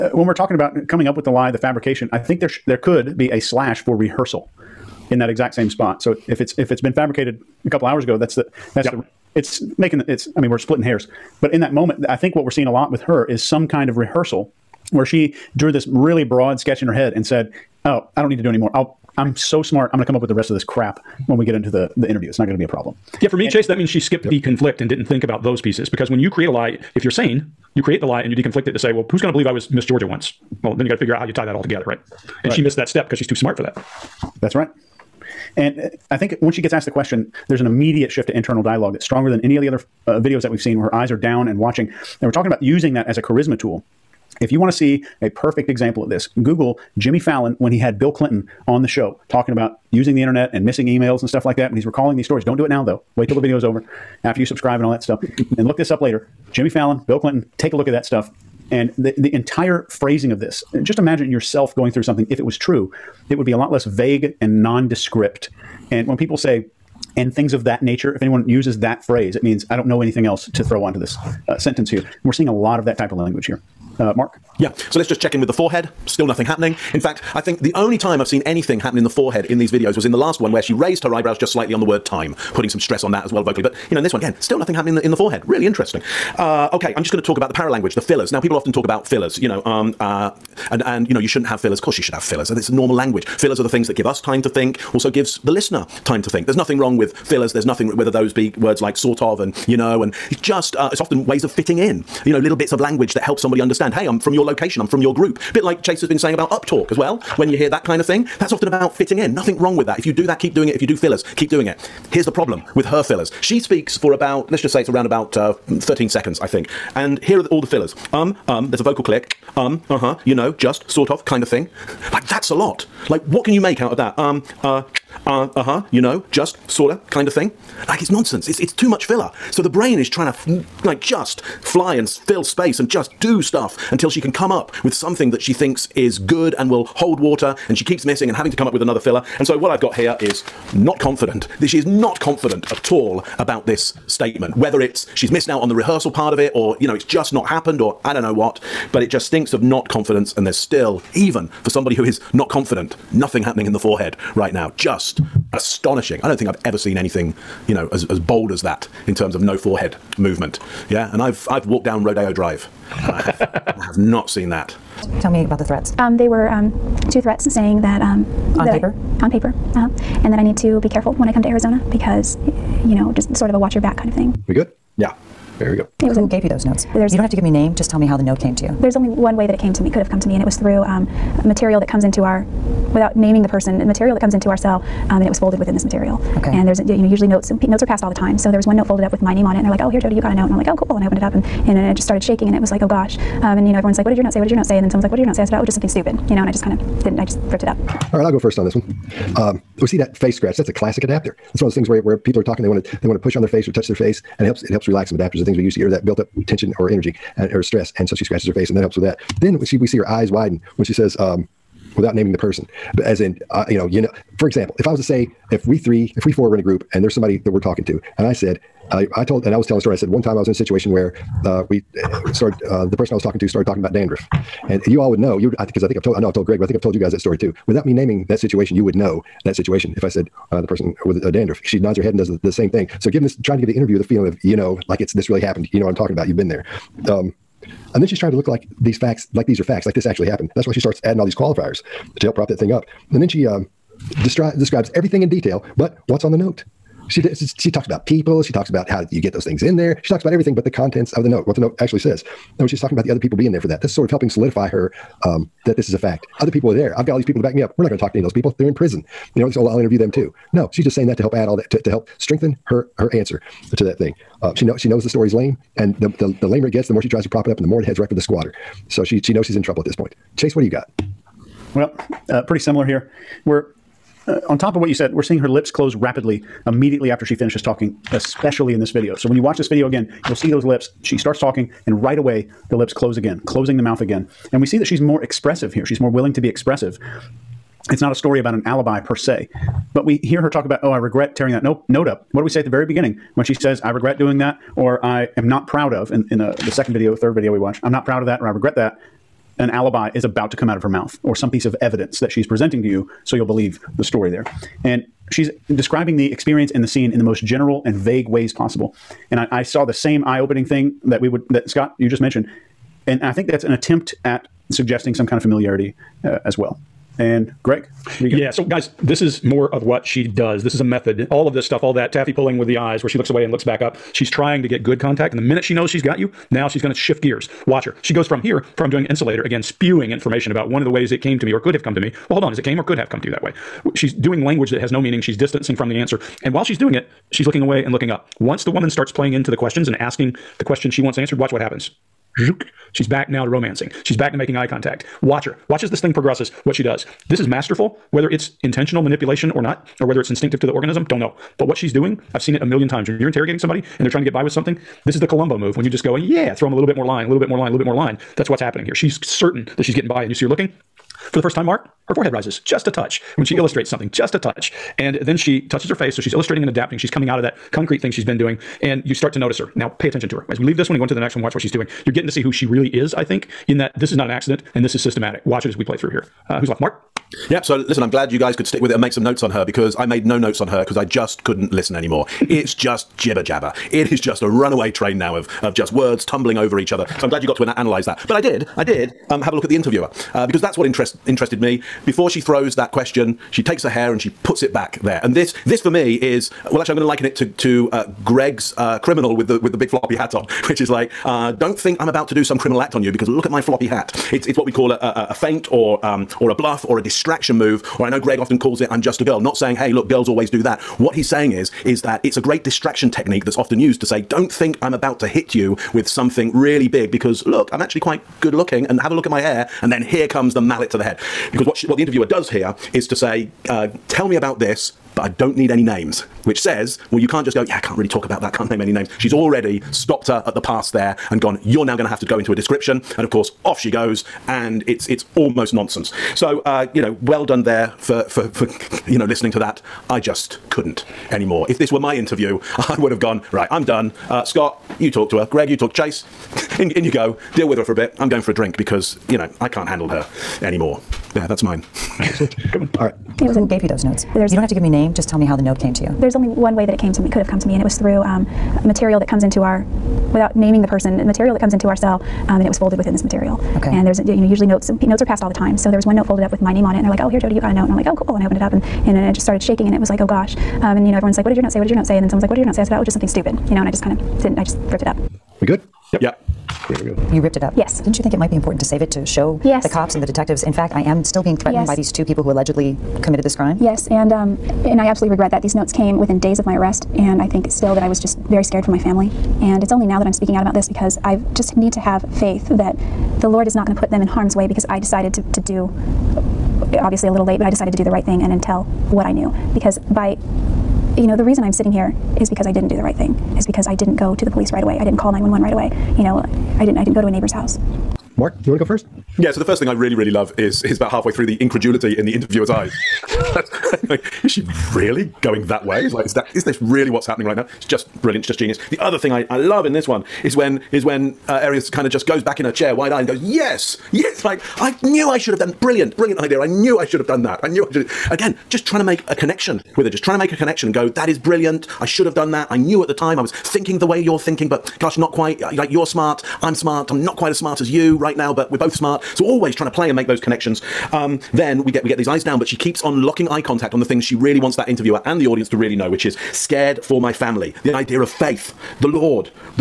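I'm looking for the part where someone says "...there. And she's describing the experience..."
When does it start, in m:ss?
5:04.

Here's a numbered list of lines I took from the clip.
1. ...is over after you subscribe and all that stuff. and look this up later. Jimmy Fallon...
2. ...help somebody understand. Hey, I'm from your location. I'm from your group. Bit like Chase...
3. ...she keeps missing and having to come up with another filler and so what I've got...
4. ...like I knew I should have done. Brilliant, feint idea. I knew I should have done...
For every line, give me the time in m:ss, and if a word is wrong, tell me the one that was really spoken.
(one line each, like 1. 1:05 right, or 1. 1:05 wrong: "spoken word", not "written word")
1. 0:53 right
2. 1:43 right
3. 2:17 right
4. 8:44 wrong: "brilliant", not "feint".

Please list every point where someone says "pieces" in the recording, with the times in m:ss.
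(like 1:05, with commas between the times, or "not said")
0:25, 5:01.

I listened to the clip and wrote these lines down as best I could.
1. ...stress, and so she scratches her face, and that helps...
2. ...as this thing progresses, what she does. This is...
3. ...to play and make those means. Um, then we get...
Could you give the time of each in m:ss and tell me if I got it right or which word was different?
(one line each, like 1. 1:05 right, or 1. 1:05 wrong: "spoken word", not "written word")
1. 3:27 right
2. 5:45 right
3. 8:59 wrong: "connections", not "means".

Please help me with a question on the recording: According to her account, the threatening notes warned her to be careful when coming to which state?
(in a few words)
Arizona.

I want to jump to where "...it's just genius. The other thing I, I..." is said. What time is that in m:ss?
8:38.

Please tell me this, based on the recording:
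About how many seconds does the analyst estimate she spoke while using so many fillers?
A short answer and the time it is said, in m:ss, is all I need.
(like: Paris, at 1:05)
13, at 1:55.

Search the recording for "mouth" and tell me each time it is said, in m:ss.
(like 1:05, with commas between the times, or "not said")
4:43, 5:00.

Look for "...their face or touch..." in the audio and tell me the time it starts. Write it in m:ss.
3:23.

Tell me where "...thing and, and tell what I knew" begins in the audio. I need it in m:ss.
8:18.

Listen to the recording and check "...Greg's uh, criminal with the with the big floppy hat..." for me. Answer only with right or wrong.
right.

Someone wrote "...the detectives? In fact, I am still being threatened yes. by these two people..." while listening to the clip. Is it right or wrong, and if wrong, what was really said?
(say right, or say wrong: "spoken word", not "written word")
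right.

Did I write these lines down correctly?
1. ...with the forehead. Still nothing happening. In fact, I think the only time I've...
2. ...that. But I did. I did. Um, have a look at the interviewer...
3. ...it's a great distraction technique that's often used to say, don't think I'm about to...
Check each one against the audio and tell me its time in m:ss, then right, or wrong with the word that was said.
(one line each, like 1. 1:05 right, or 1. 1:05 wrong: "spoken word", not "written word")
1. 1:15 right
2. 6:28 right
3. 6:52 right.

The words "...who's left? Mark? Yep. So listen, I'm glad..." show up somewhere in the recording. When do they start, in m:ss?
6:16.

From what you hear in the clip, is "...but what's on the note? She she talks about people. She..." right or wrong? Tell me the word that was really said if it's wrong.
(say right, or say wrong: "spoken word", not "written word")
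right.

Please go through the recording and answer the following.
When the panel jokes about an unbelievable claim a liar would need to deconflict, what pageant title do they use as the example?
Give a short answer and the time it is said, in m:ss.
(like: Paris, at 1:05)
Miss Georgia, at 0:29.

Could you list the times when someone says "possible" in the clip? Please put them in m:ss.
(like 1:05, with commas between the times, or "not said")
5:08.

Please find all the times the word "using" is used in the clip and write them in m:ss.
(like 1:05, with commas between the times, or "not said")
0:42, 0:49.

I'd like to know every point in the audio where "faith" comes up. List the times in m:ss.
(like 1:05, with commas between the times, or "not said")
8:12, 9:08.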